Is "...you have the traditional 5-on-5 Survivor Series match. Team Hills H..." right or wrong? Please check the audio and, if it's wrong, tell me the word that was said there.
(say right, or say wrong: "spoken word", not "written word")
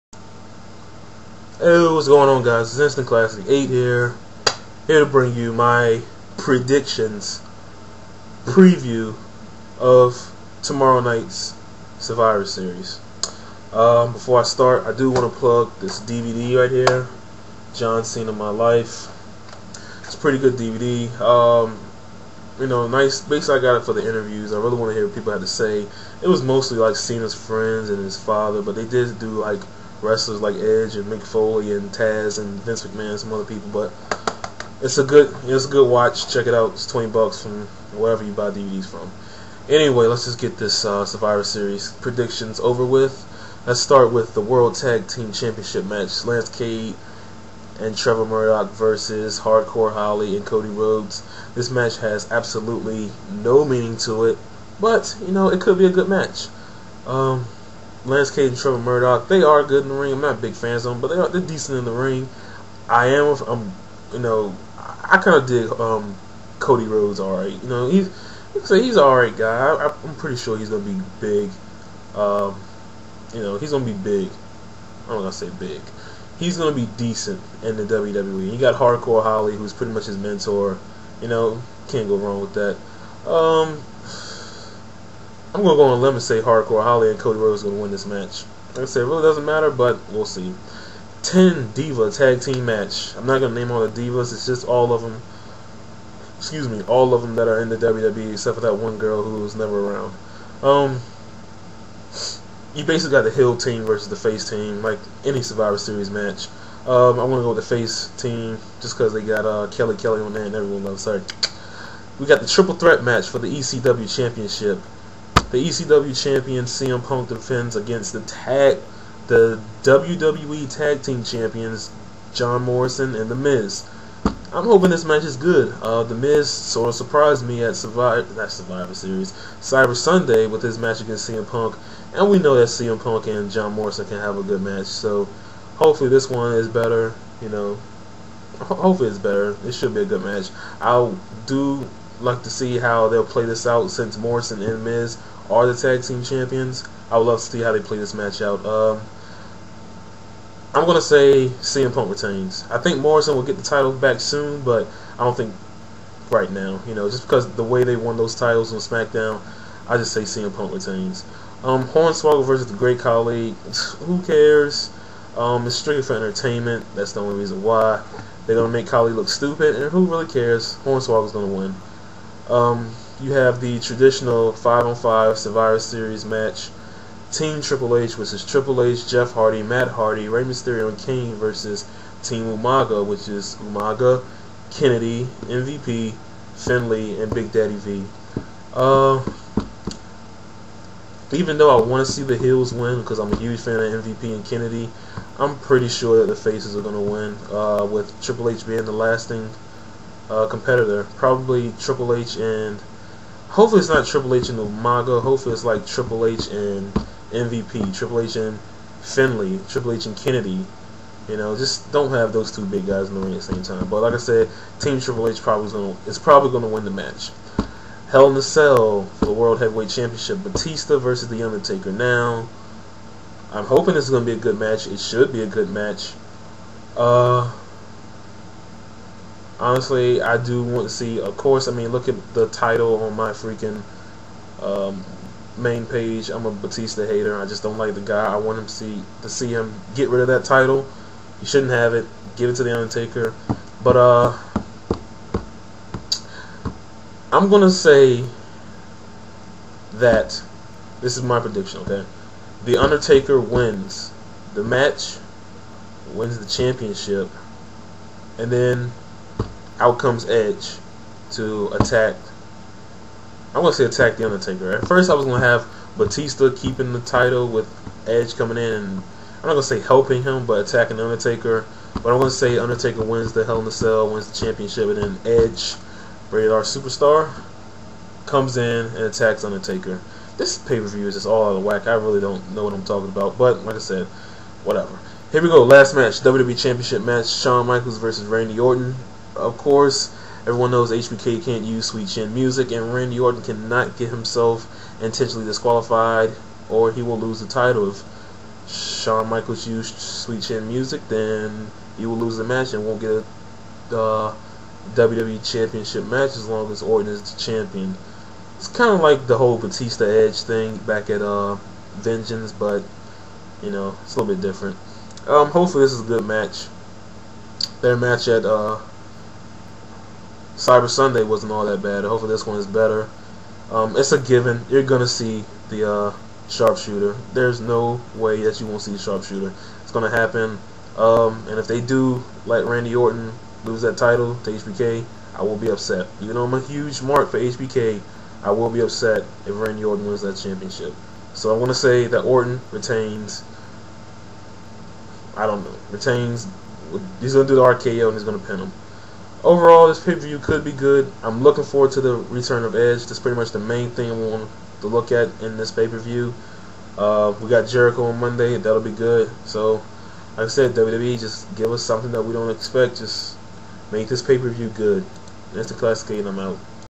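wrong: "Triple", not "Hills".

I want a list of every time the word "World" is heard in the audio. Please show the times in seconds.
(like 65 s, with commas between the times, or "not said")
44 s, 219 s.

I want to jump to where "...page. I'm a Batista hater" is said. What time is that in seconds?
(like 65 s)
235 s.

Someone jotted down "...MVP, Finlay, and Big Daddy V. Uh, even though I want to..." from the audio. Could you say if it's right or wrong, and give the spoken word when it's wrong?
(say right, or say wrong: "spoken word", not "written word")
right.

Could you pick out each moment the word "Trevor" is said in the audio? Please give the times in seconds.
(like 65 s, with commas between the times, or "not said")
47 s, 58 s.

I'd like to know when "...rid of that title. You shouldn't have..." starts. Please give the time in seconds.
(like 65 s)
240 s.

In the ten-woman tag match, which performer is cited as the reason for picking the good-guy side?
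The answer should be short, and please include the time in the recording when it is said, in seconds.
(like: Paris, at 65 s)
Kelly Kelly, at 109 s.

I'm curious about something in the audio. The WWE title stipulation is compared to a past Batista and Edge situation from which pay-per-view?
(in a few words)
Vengeance.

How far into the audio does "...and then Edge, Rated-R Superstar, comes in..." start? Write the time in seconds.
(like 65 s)
274 s.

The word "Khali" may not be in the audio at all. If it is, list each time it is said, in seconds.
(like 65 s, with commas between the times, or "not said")
162 s, 168 s.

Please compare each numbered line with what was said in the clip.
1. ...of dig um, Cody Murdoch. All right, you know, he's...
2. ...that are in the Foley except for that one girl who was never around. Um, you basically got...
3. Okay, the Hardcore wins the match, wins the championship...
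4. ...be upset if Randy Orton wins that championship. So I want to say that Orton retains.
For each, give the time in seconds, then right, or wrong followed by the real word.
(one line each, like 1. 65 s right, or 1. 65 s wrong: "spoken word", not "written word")
1. 65 s wrong: "Rhodes", not "Murdoch"
2. 97 s wrong: "WWE", not "Foley"
3. 251 s wrong: "Undertaker", not "Hardcore"
4. 338 s right.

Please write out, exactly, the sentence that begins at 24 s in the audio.
I really want to hear what people had to say.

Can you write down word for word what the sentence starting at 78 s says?
He got Hardcore Holly, who's pretty much his mentor.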